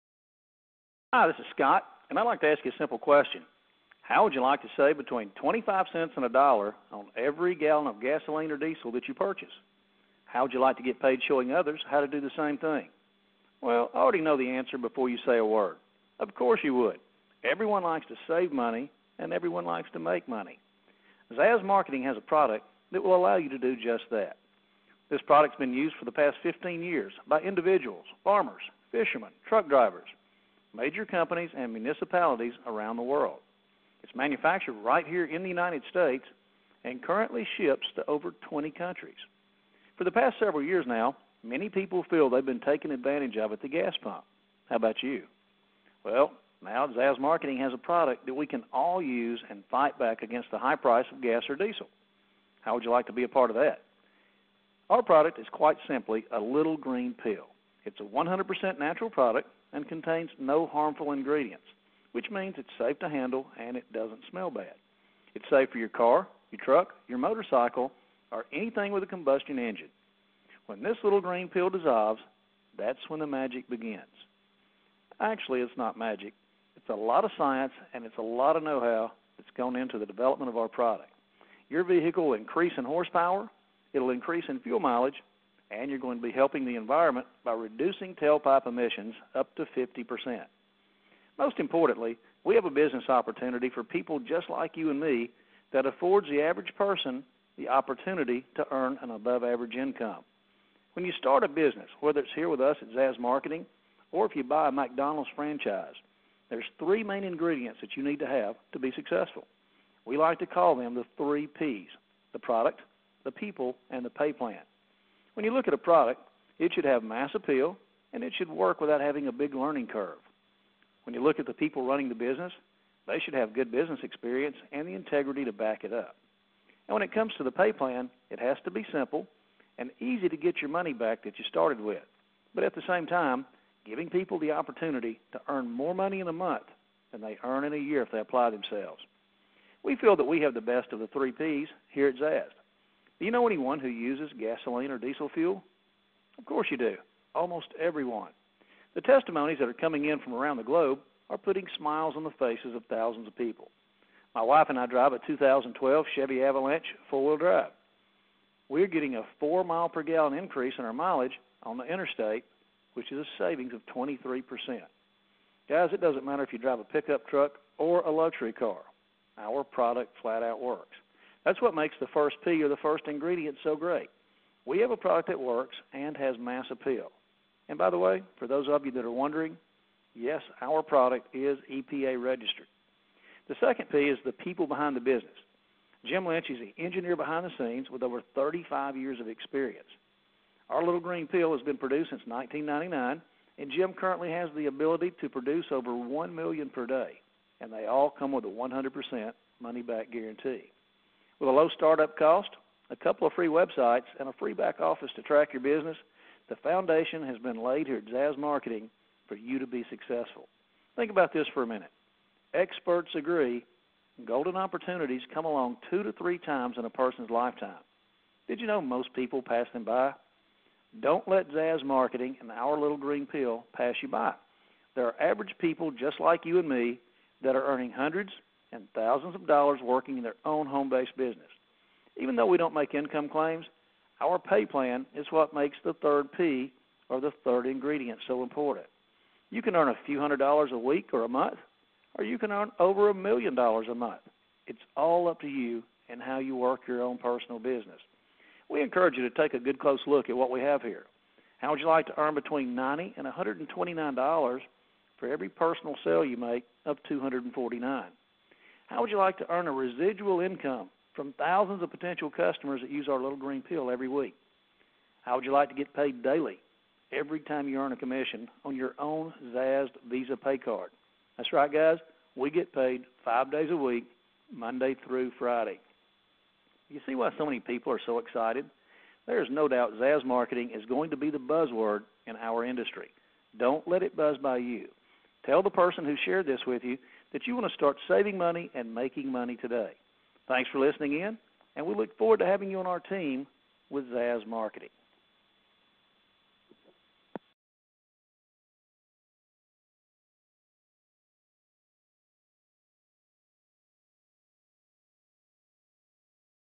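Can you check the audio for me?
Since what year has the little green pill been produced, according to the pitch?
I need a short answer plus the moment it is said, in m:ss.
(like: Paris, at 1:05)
1999, at 3:12.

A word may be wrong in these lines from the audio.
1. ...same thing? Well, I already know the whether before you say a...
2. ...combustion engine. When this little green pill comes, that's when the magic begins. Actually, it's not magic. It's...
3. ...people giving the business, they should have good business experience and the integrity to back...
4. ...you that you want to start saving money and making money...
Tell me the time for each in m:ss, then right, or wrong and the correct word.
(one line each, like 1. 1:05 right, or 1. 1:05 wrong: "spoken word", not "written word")
1. 0:12 wrong: "answer", not "whether"
2. 1:09 wrong: "dissolves", not "comes"
3. 2:01 wrong: "running", not "giving"
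4. 4:46 right.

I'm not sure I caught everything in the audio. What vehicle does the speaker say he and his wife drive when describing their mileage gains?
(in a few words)
2012 Chevy Avalanche.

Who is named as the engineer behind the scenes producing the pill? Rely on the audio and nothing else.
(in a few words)
Jim Lynch.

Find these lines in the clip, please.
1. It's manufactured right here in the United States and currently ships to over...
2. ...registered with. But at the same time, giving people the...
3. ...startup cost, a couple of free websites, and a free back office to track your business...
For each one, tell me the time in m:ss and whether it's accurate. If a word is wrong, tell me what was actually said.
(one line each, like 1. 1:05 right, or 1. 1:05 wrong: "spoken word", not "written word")
1. 0:34 right
2. 2:11 wrong: "started", not "registered"
3. 3:21 right.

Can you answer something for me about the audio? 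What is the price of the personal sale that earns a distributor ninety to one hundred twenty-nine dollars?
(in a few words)
$249.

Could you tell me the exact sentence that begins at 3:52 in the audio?
Even though we don't make income claims, our pay plan is what makes the third P or the third ingredient so important.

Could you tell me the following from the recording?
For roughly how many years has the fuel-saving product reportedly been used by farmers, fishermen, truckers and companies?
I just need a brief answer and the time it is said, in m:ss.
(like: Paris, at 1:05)
15, at 0:26.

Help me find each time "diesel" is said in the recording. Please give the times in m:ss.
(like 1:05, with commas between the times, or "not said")
0:08, 0:51, 2:24.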